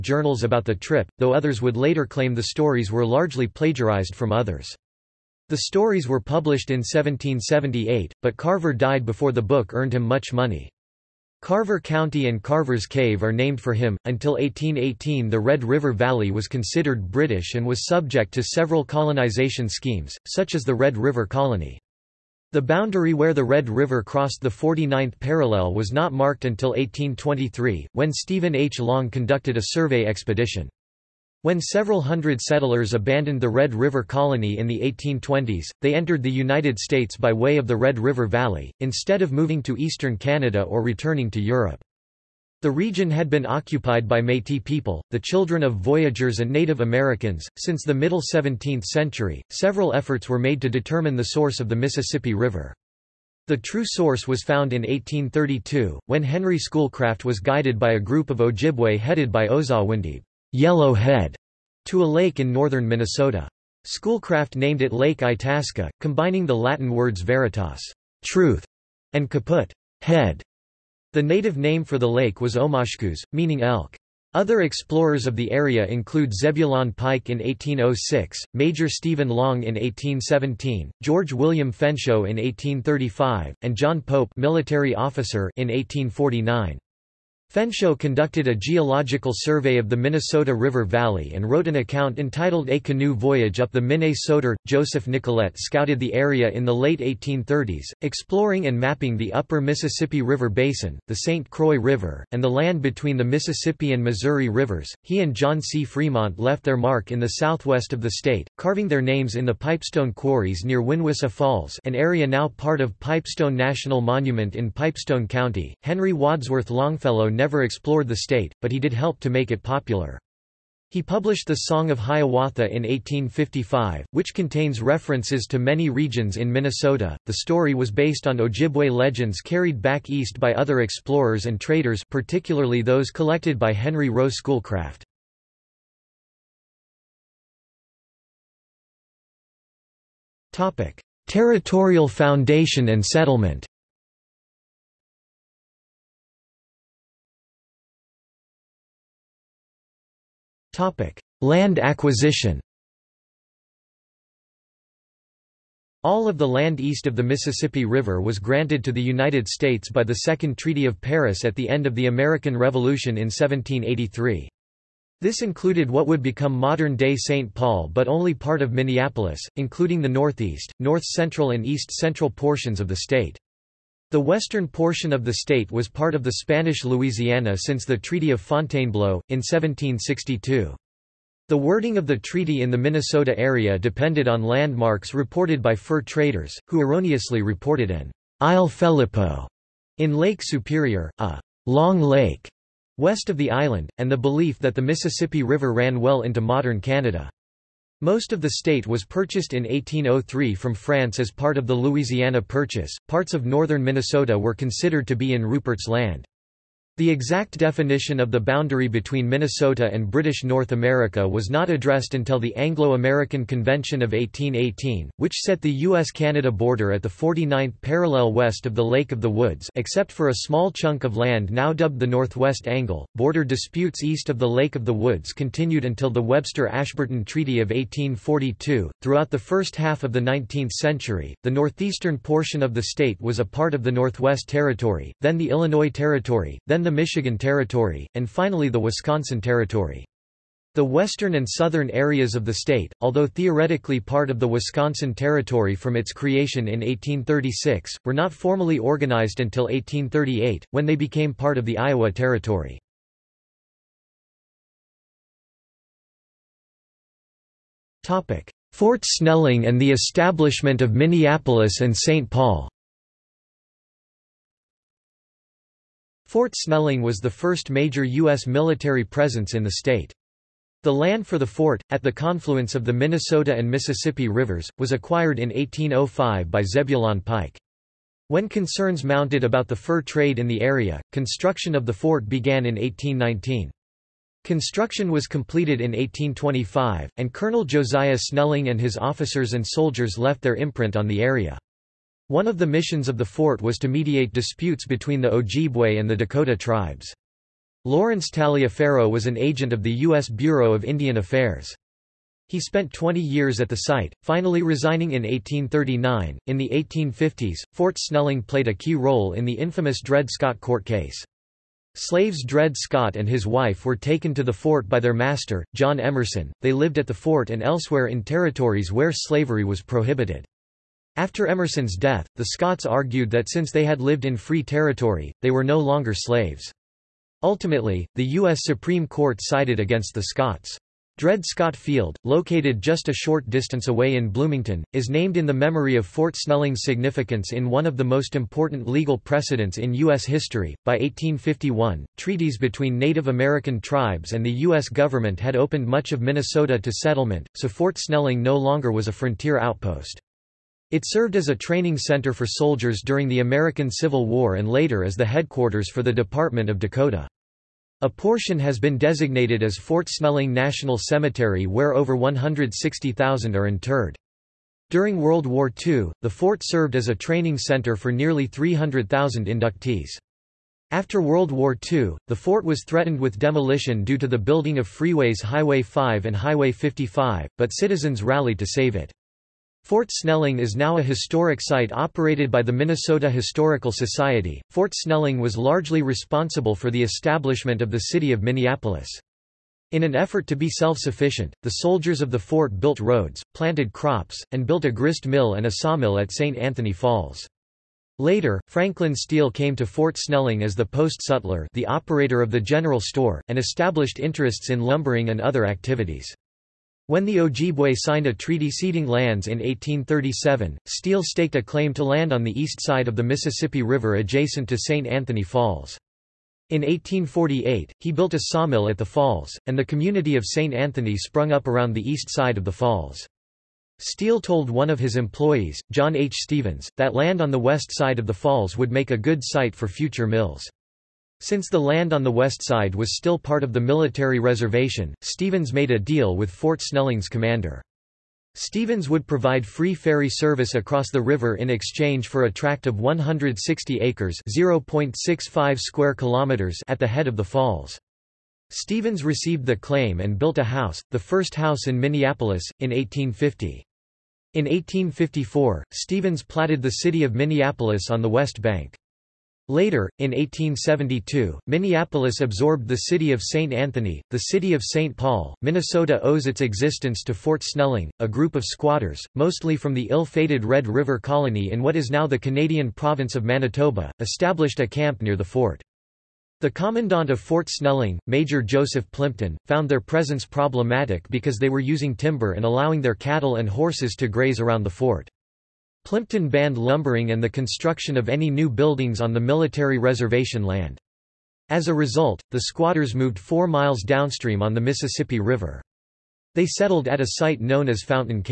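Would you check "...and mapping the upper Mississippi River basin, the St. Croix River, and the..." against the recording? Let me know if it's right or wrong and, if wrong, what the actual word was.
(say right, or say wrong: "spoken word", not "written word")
right.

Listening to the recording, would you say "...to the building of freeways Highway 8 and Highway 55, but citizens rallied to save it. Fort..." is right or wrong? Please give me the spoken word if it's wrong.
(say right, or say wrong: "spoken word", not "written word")
wrong: "5", not "8".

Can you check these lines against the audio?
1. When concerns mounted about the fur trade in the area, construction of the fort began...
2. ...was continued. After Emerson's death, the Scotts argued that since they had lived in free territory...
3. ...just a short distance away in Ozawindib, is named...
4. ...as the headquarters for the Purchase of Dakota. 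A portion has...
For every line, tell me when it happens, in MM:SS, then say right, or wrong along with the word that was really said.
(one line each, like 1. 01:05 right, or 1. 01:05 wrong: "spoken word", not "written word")
1. 04:38 right
2. 05:19 wrong: "prohibited", not "continued"
3. 05:32 wrong: "Bloomington", not "Ozawindib"
4. 05:55 wrong: "Department", not "Purchase".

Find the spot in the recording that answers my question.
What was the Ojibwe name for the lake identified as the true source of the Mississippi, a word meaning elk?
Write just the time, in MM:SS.
01:12.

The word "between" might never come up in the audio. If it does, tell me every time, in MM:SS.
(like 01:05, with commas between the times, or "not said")
01:42, 03:28, 04:54, 05:42.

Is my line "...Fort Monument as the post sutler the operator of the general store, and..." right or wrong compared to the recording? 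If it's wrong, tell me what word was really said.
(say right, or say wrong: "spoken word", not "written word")
wrong: "Snelling", not "Monument".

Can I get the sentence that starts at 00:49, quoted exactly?
Several efforts were made to determine the source of the Mississippi River.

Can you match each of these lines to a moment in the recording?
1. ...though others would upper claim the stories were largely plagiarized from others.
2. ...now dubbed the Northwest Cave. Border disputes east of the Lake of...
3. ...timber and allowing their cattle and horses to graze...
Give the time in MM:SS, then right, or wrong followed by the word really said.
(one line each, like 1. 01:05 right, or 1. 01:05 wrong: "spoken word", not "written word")
1. 00:01 wrong: "later", not "upper"
2. 03:41 wrong: "Angle", not "Cave"
3. 08:02 right.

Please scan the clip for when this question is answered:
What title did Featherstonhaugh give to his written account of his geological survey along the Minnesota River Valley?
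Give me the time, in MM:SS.
01:32.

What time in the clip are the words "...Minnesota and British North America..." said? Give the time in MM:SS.
03:29.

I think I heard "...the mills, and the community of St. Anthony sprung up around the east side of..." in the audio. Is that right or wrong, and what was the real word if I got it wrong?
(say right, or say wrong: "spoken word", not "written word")
wrong: "falls", not "mills".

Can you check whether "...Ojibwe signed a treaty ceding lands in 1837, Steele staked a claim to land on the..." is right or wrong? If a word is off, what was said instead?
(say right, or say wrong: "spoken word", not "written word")
right.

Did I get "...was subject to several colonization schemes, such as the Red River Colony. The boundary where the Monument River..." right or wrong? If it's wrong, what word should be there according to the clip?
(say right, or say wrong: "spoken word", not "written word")
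wrong: "Red", not "Monument".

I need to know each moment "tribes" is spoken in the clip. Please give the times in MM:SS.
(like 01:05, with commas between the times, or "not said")
04:56, 05:43.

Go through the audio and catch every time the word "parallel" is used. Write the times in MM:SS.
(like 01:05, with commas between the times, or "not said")
00:25, 03:37.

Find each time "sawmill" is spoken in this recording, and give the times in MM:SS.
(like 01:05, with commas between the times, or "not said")
06:35, 06:58.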